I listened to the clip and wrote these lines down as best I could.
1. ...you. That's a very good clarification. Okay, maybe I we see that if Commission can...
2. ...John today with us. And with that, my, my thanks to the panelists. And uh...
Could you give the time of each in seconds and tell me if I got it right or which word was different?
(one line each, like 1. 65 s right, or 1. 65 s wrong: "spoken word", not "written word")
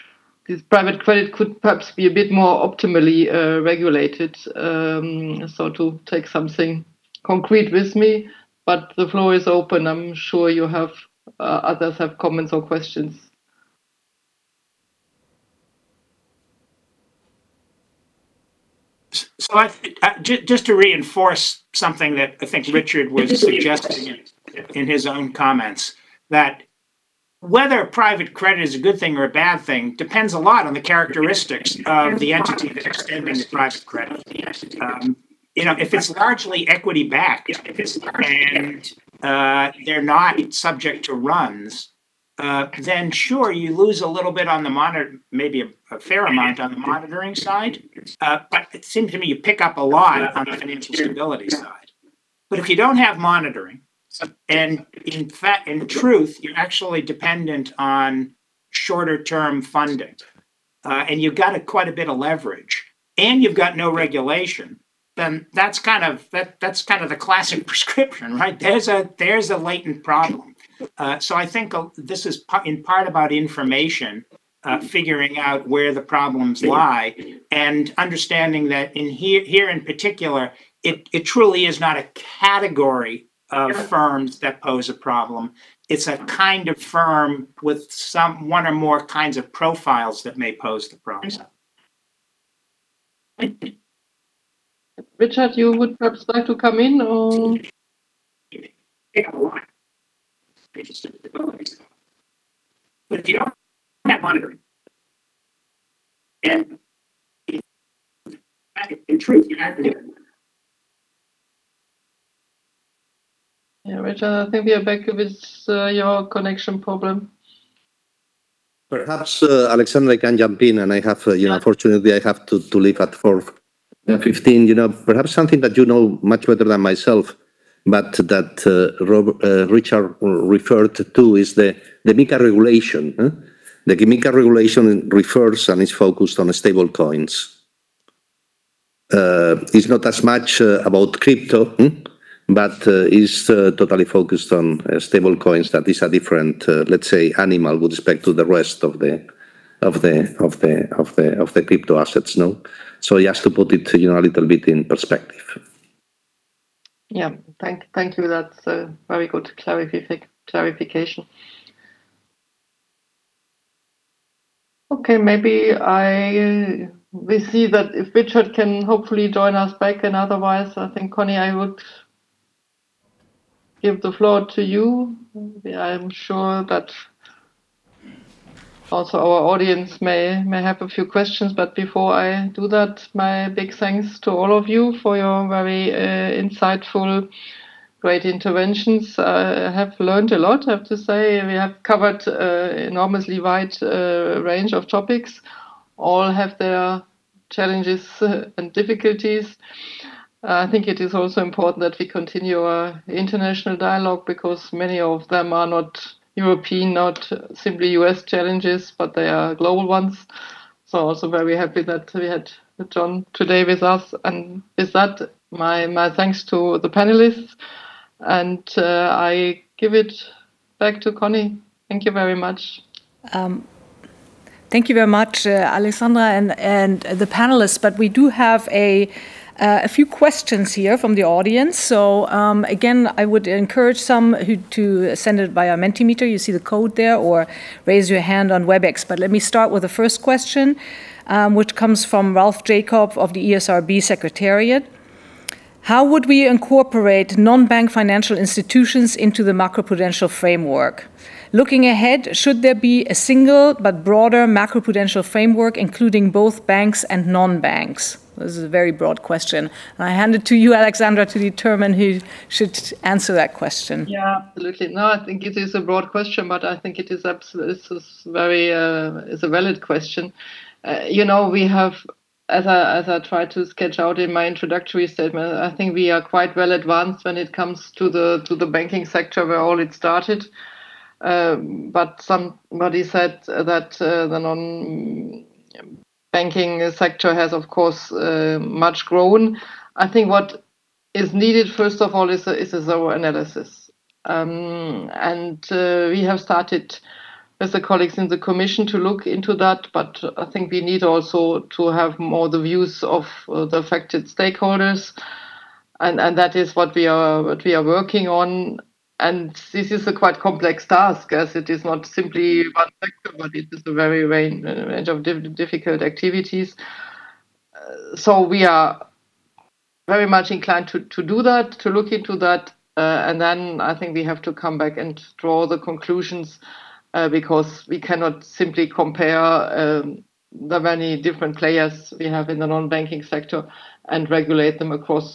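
1. 158 s wrong: "Richard", not "Commission"
2. 212 s right.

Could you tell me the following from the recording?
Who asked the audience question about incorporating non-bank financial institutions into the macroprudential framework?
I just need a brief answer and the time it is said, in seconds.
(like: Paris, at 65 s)
Ralph Jacob, at 242 s.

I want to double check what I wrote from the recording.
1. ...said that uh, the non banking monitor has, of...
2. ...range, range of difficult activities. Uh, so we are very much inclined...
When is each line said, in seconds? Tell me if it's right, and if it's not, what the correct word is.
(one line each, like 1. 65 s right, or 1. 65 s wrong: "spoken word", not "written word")
1. 283 s wrong: "sector", not "monitor"
2. 314 s right.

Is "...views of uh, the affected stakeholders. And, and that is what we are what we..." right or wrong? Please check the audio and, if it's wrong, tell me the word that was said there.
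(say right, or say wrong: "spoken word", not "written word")
right.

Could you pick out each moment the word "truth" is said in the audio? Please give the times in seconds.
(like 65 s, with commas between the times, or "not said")
55 s, 109 s.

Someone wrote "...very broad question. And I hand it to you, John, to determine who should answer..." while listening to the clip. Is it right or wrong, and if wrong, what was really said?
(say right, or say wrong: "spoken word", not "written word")
wrong: "Alexandra", not "John".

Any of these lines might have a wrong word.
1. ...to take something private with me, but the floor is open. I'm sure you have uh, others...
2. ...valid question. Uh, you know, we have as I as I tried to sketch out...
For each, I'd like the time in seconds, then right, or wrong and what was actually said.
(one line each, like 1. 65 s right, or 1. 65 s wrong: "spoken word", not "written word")
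1. 5 s wrong: "concrete", not "private"
2. 269 s right.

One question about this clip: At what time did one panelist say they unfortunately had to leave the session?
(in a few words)
4:15.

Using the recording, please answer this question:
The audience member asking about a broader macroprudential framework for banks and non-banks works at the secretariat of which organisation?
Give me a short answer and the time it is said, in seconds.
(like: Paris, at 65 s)
ESRB, at 243 s.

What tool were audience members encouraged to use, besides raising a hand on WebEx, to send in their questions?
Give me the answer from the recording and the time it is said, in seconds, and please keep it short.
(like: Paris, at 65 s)
Mentimeter, at 235 s.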